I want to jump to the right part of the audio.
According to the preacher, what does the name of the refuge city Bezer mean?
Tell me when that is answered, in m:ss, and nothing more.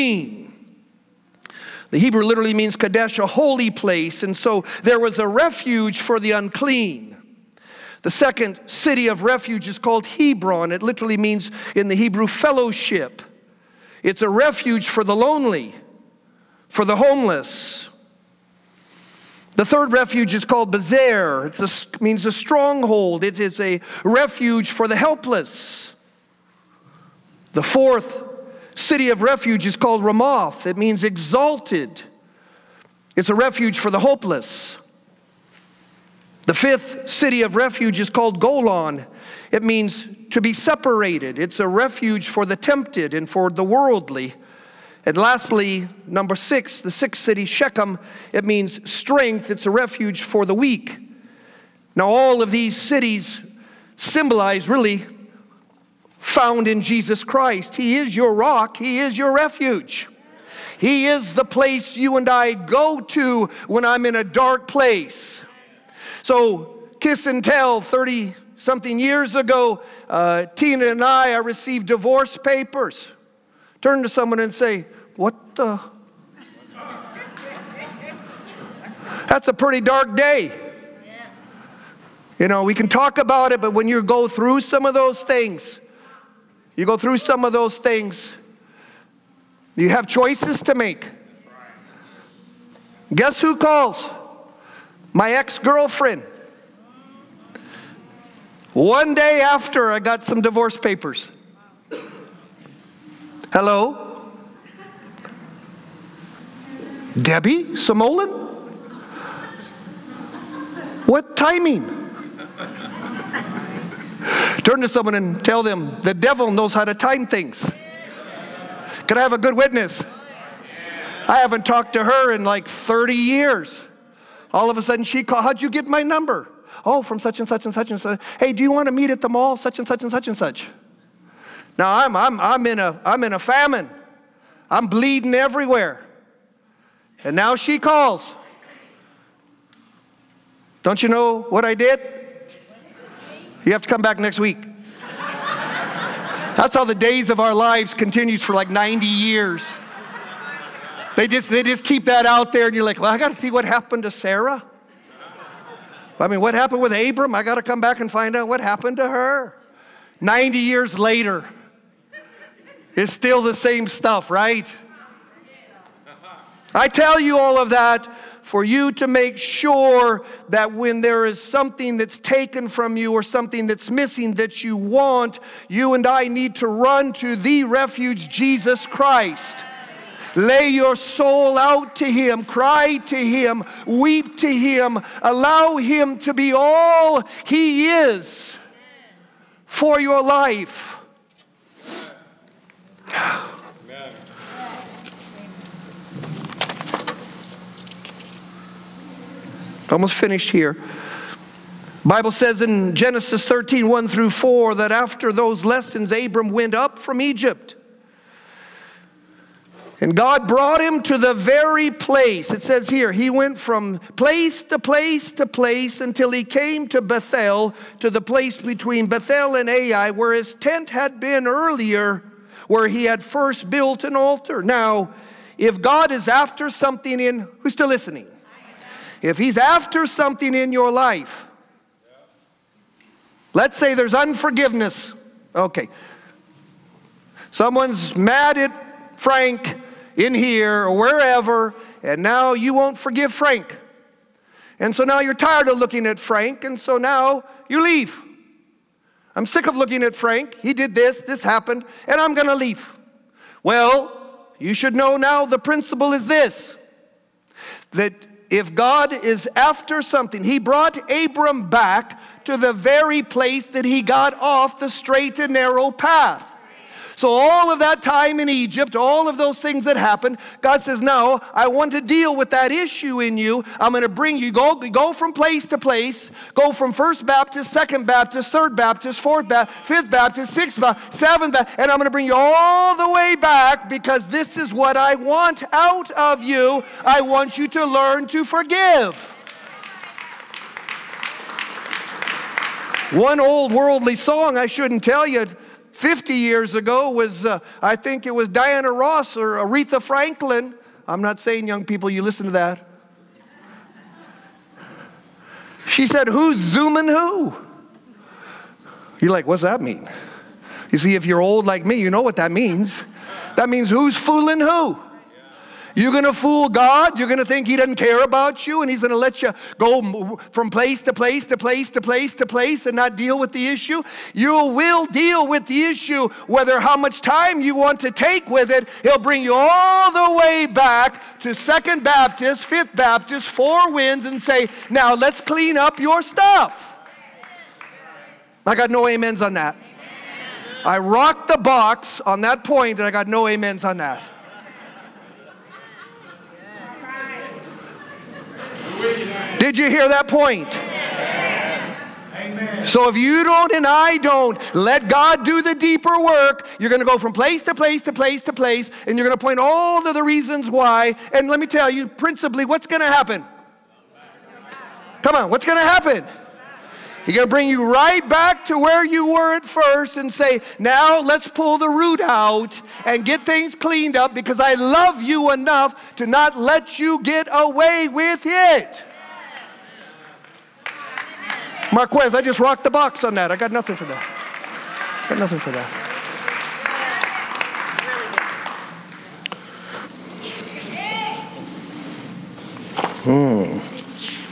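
0:22.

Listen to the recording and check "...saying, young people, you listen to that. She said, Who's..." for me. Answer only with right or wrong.
right.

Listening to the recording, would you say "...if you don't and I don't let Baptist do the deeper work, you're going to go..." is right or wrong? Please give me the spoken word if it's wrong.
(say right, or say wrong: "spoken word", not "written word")
wrong: "God", not "Baptist".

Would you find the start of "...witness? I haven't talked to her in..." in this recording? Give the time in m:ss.
1:59.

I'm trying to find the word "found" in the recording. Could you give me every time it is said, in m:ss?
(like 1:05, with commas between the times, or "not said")
0:56.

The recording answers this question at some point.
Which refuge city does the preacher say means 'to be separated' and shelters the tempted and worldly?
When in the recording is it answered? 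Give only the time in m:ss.
0:38.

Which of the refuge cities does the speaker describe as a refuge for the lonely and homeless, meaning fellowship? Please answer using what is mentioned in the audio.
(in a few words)
Hebron.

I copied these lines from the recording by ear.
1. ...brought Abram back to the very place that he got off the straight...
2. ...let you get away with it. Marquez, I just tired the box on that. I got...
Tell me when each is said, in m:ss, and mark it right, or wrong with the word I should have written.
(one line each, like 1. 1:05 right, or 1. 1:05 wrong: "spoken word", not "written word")
1. 4:20 right
2. 6:16 wrong: "rocked", not "tired".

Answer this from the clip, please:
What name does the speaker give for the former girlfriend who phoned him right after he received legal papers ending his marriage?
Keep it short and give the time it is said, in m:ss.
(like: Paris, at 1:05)
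Debbie Samolin, at 1:47.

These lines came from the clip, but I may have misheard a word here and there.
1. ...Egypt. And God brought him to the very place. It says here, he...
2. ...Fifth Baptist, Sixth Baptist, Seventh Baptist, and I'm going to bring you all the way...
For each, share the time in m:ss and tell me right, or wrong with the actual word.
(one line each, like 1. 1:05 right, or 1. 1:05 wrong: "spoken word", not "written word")
1. 3:27 right
2. 4:39 right.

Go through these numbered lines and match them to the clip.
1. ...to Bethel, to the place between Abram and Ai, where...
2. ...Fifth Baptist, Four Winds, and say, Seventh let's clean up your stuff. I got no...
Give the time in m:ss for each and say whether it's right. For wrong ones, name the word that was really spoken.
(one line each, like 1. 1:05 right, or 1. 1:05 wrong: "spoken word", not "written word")
1. 3:36 wrong: "Bethel", not "Abram"
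2. 5:32 wrong: "Now", not "Seventh".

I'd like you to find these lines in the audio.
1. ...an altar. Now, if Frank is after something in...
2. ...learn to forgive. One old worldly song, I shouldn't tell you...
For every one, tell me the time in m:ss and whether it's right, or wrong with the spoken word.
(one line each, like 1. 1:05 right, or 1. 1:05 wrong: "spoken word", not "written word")
1. 3:44 wrong: "God", not "Frank"
2. 4:47 right.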